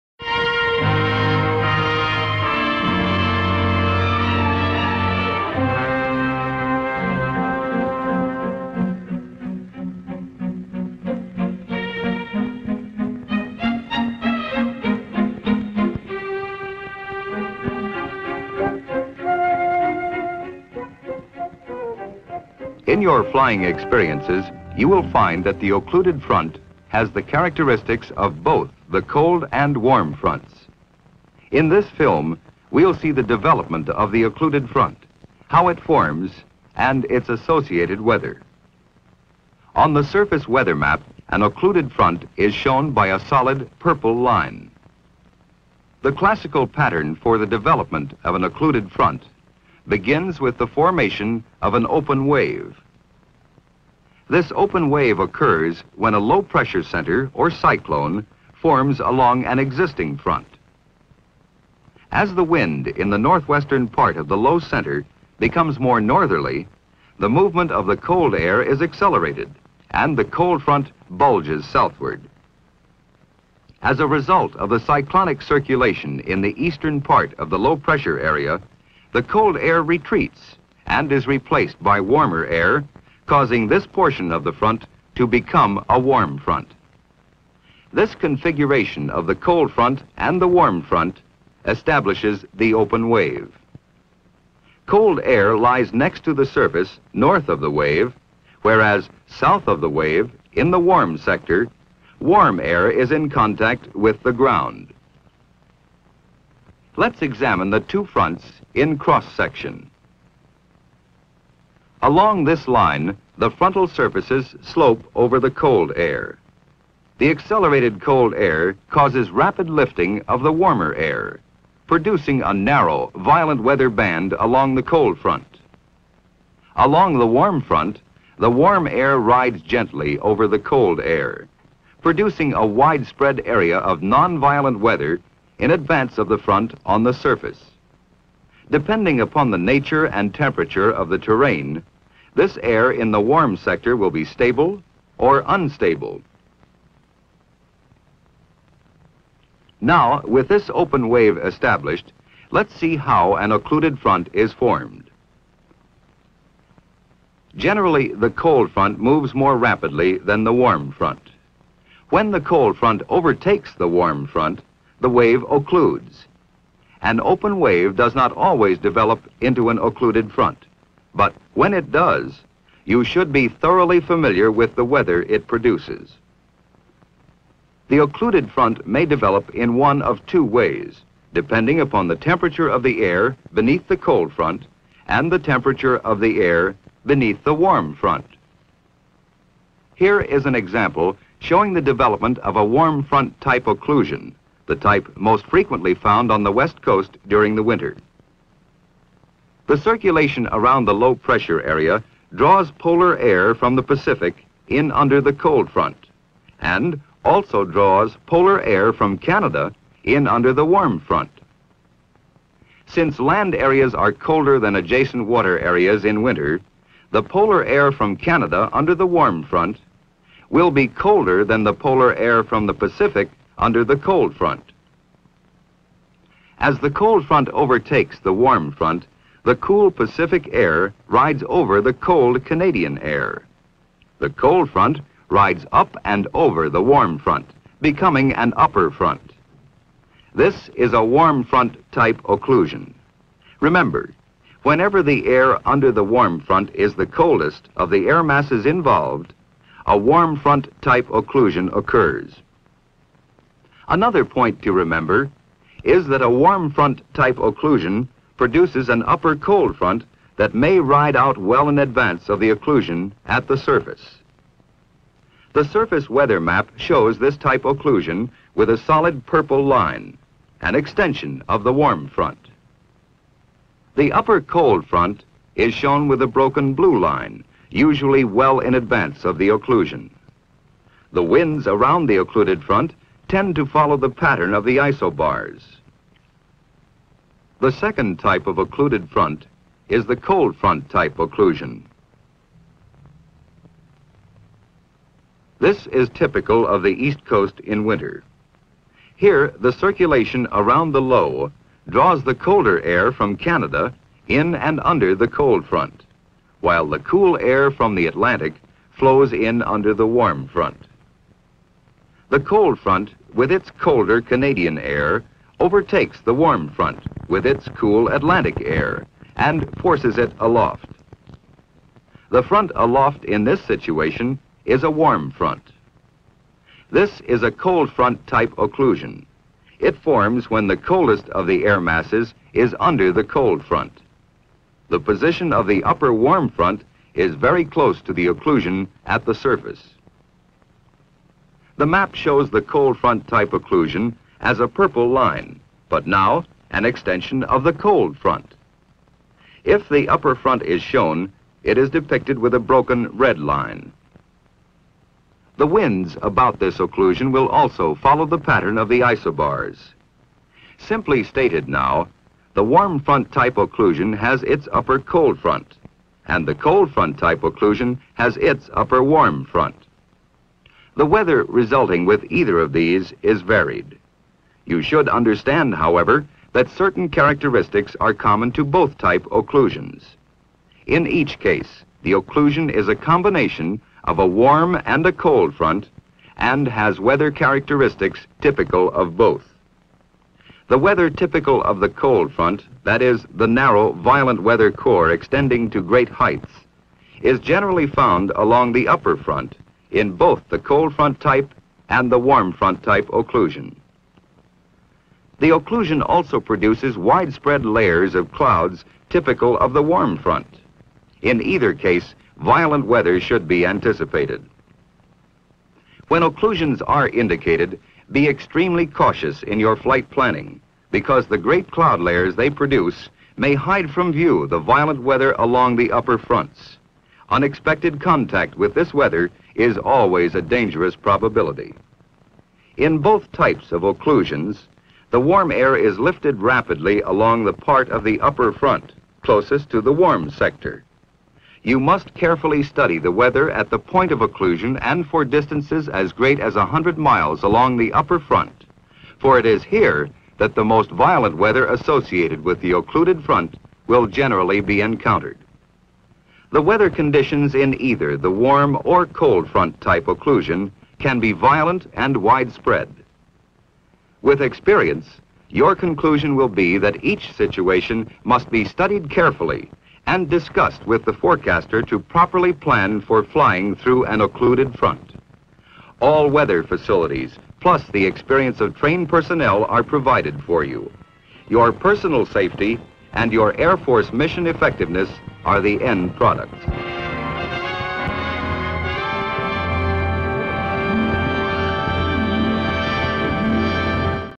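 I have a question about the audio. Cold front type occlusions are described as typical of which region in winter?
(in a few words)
East Coast.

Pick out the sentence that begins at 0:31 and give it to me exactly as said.
In this film, we'll see the development of the occluded front, how it forms, and its associated weather.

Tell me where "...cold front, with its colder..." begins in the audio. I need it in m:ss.
5:12.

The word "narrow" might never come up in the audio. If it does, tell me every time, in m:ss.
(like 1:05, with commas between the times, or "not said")
2:02, 6:33.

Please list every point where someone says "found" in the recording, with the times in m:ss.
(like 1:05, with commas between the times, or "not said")
3:15, 6:37.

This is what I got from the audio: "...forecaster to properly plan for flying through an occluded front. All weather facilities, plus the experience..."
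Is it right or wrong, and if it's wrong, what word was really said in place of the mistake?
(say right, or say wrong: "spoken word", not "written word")
right.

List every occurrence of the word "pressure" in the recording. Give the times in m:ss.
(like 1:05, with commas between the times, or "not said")
0:56, 1:17, 3:21.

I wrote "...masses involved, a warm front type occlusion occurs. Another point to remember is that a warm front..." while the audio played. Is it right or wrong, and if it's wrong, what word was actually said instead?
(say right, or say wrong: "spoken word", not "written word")
right.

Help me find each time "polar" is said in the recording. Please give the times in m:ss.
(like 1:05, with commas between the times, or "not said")
3:22, 3:28, 3:37, 3:41.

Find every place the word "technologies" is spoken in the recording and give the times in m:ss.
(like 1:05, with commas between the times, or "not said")
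not said.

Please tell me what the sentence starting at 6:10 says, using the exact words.
The weather resulting with either of these is varied.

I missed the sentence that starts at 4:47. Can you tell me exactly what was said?
The second type of occluded front is the cold front type occlusion.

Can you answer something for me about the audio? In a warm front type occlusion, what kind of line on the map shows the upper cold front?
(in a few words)
Broken blue line.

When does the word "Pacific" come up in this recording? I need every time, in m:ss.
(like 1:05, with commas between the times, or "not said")
3:23, 3:42, 3:49.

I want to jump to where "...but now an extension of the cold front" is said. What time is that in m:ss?
5:45.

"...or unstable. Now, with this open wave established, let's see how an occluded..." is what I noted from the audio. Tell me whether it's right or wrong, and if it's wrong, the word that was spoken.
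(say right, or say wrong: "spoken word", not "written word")
right.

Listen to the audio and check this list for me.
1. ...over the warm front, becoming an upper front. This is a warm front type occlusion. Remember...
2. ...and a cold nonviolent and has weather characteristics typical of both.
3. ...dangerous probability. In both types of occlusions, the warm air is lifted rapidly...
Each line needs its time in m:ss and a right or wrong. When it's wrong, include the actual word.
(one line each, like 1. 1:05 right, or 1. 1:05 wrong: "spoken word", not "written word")
1. 3:56 right
2. 6:24 wrong: "front", not "nonviolent"
3. 7:10 right.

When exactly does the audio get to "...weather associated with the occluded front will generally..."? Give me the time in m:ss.
7:31.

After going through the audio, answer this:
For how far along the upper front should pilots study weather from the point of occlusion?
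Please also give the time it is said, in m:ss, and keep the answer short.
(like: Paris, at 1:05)
100 miles, at 7:26.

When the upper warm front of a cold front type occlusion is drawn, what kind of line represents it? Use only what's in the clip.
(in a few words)
Broken red line.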